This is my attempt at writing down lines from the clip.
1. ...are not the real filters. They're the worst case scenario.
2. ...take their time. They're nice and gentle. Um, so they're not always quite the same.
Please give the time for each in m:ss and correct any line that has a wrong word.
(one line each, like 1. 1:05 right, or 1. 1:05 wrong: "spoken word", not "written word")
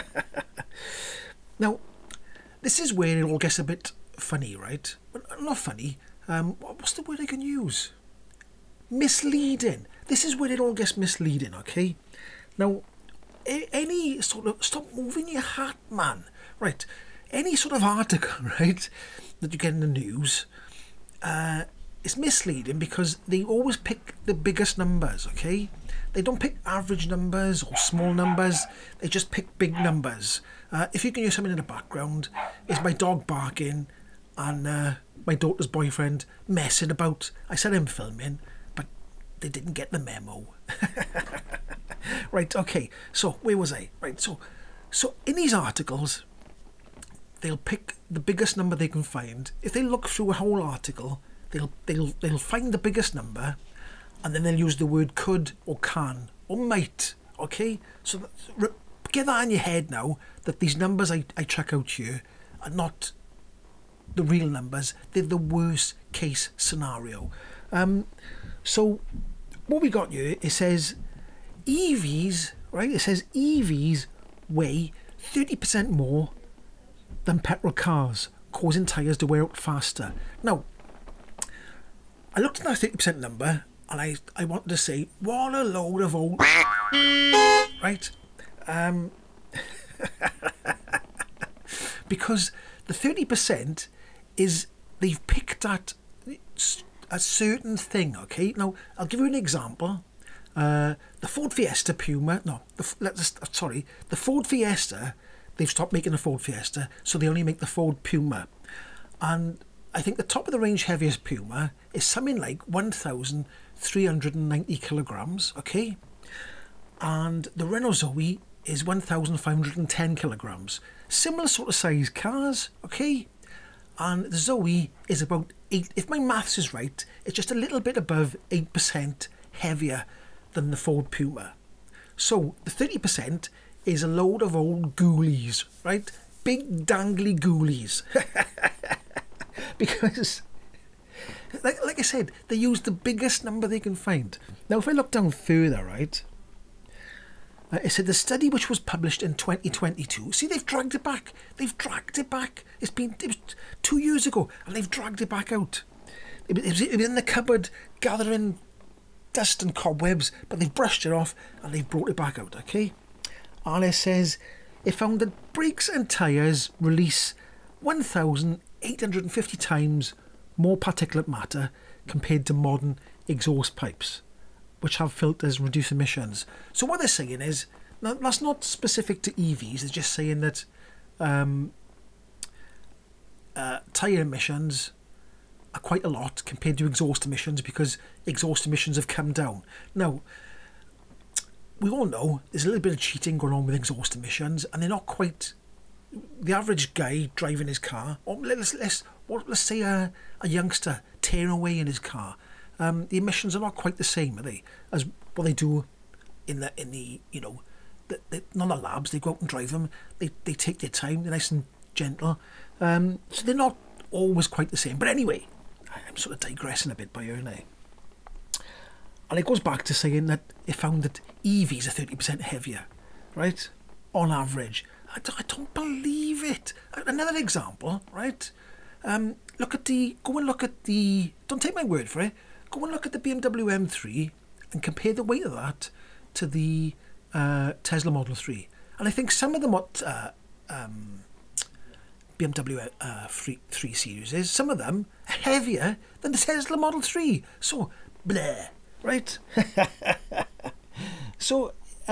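1. 1:02 wrong: "numbers", not "filters"
2. 3:30 right.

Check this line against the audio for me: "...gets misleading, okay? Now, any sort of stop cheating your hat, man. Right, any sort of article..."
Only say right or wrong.
wrong.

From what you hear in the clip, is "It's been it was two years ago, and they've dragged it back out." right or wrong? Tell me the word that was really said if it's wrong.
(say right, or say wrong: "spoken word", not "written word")
right.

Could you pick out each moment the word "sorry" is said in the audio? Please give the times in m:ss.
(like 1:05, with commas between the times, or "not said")
1:43.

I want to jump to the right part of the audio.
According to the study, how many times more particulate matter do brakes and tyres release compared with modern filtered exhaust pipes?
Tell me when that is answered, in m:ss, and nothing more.
2:47.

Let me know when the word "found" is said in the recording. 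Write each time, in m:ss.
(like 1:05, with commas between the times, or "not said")
2:44, 3:40.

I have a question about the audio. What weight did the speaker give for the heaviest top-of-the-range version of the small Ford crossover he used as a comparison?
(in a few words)
1,390 kilograms.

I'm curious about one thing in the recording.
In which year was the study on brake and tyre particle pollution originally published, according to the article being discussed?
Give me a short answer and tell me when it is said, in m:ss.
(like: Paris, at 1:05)
2022, at 2:29.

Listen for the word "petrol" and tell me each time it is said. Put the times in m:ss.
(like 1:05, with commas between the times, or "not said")
1:17.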